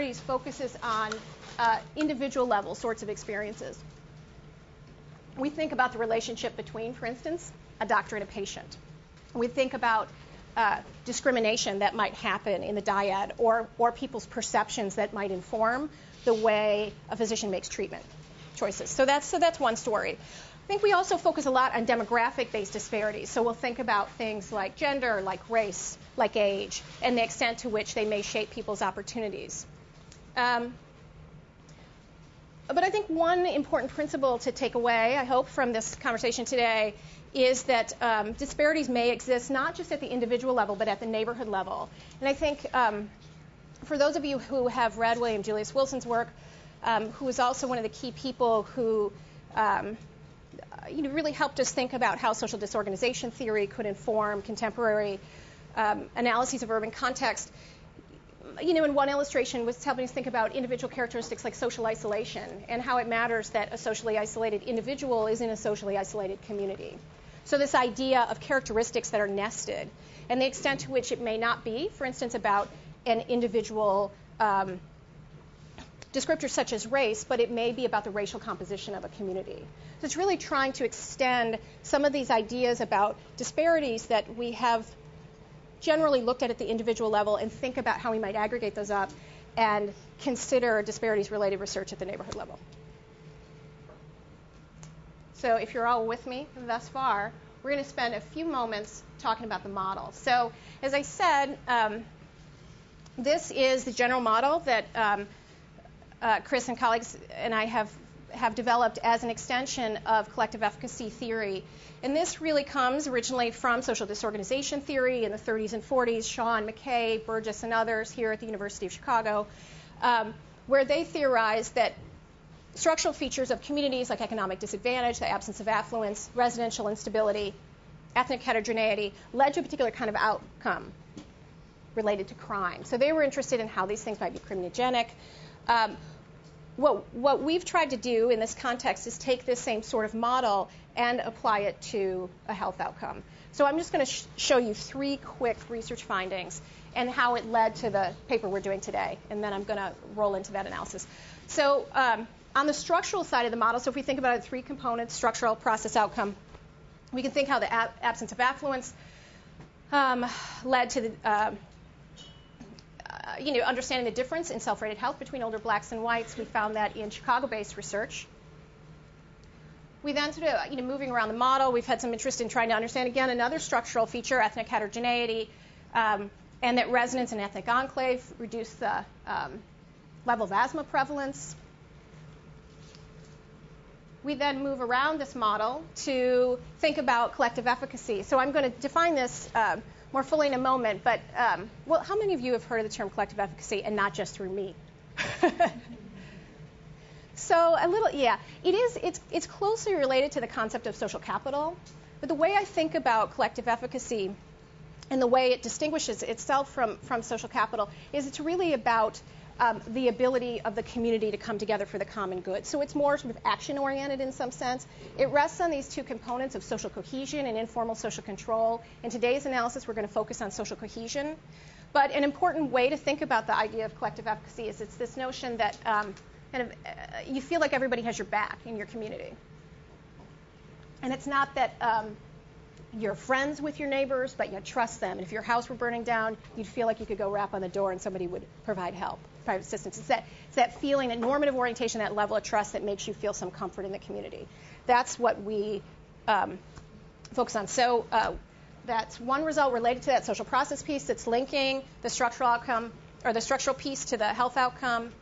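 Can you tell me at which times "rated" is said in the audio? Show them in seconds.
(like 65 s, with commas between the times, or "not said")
164 s.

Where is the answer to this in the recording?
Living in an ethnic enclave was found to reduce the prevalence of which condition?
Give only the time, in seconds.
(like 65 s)
180 s.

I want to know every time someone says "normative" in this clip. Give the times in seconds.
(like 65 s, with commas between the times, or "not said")
241 s.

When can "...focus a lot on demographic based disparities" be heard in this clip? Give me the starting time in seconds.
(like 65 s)
21 s.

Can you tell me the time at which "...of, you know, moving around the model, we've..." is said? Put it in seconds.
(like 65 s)
170 s.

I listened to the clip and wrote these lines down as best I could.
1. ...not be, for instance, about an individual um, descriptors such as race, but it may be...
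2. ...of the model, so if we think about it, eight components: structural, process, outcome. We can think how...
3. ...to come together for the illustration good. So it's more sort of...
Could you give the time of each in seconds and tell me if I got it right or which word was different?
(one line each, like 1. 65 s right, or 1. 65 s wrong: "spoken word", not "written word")
1. 71 s right
2. 153 s wrong: "three", not "eight"
3. 211 s wrong: "common", not "illustration".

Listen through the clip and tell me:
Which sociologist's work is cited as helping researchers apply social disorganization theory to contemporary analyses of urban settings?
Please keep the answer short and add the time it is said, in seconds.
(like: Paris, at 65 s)
William Julius Wilson, at 45 s.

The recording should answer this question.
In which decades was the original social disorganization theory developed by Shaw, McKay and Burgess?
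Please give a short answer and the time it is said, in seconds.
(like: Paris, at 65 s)
the 30s and 40s, at 115 s.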